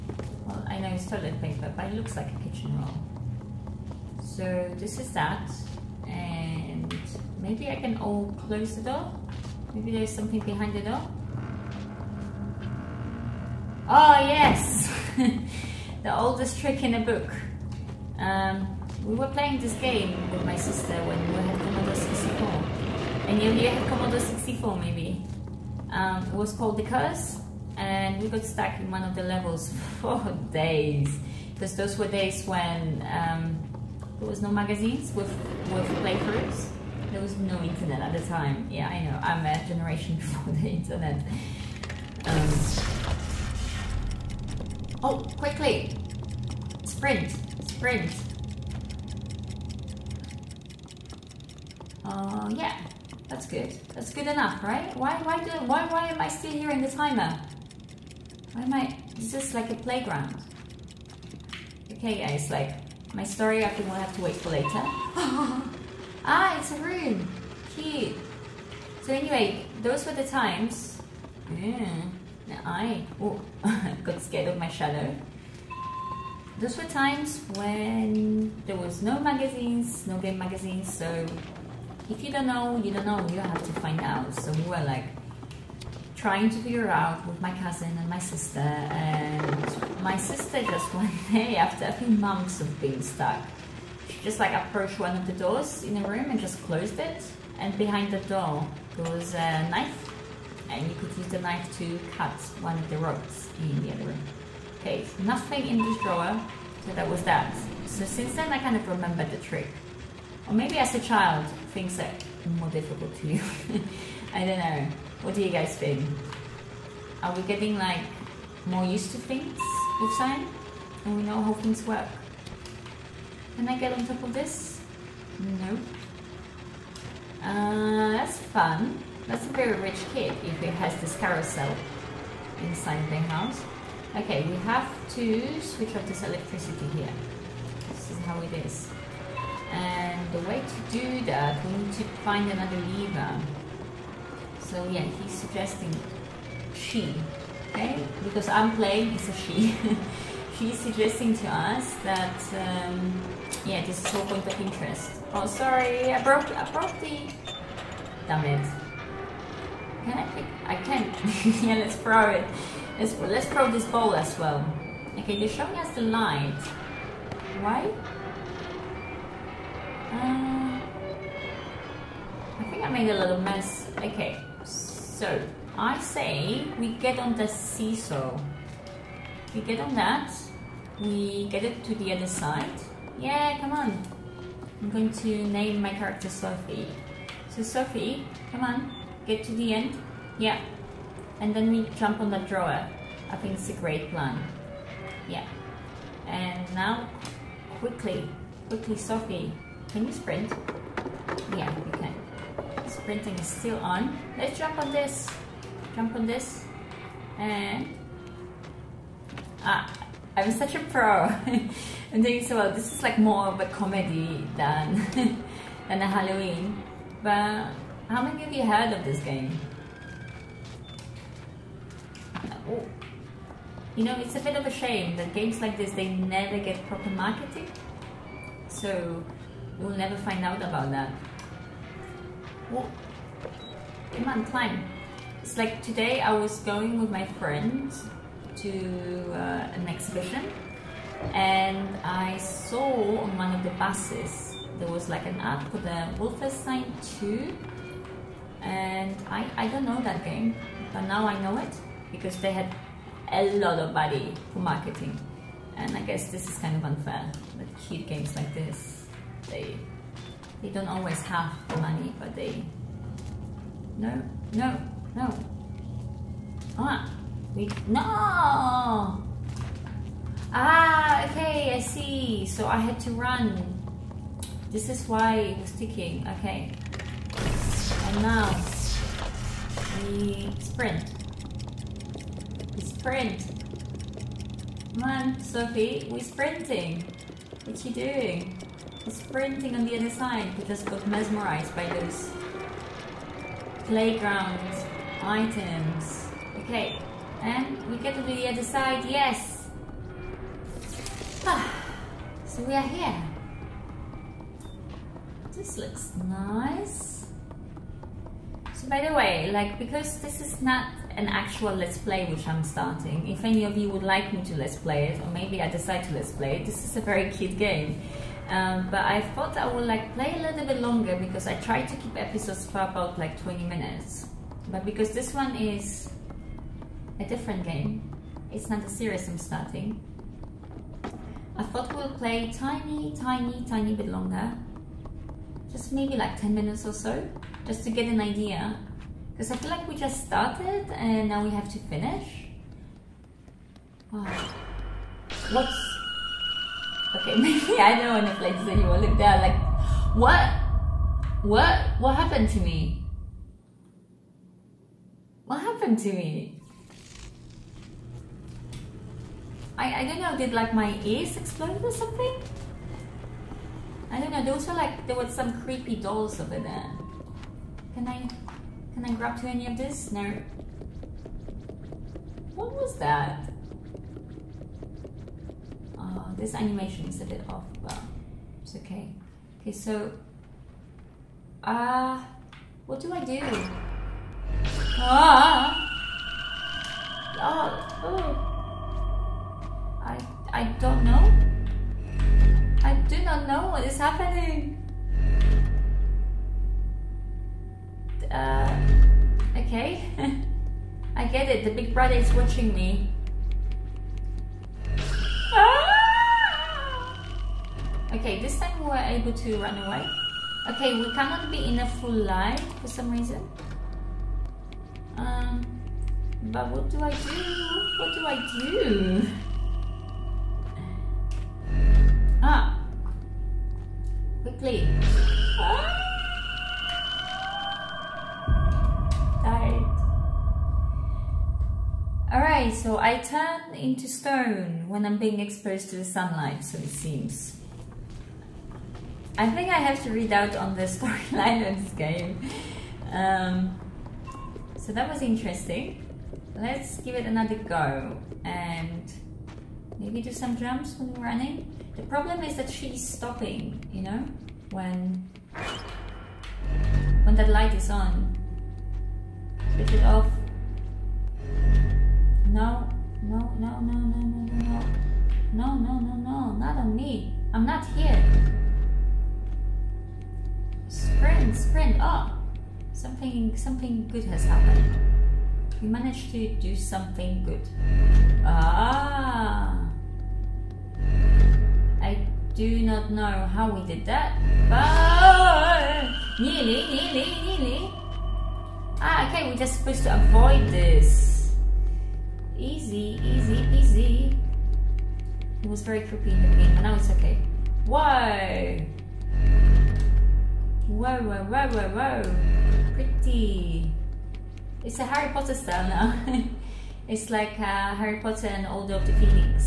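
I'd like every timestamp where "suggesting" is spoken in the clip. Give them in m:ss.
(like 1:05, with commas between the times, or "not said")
2:25, 2:30.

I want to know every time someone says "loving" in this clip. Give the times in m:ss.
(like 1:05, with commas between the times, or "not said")
not said.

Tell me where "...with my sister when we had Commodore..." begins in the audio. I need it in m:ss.
0:20.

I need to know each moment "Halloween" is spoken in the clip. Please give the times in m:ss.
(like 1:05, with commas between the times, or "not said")
3:36.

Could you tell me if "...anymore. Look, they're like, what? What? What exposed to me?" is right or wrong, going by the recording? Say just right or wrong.
wrong.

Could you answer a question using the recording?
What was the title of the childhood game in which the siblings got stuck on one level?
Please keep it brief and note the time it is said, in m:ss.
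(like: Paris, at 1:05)
The Curse, at 0:26.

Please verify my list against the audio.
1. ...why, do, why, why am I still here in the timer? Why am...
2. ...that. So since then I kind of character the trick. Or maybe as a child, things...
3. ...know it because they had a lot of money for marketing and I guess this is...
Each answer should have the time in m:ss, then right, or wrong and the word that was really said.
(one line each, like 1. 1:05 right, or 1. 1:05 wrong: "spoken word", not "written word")
1. 0:55 right
2. 1:47 wrong: "remember", not "character"
3. 4:11 right.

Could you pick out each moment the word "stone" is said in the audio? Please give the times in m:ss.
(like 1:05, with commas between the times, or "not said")
7:14.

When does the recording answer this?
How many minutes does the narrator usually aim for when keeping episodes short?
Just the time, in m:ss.
5:23.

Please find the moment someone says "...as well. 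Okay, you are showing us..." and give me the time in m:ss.
2:44.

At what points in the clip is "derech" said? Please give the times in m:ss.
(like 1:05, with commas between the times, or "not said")
not said.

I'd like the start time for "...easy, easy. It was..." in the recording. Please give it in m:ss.
8:13.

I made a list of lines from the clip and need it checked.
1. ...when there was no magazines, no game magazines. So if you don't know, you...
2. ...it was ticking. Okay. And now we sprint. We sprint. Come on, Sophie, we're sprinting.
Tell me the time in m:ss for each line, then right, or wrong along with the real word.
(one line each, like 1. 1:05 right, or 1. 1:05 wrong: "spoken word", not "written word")
1. 1:17 right
2. 4:35 right.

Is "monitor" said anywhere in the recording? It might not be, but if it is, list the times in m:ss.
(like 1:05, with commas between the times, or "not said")
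not said.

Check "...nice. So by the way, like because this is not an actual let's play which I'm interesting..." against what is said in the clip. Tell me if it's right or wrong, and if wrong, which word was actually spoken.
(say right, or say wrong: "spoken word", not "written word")
wrong: "starting", not "interesting".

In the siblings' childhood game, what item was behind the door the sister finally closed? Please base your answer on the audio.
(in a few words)
A knife.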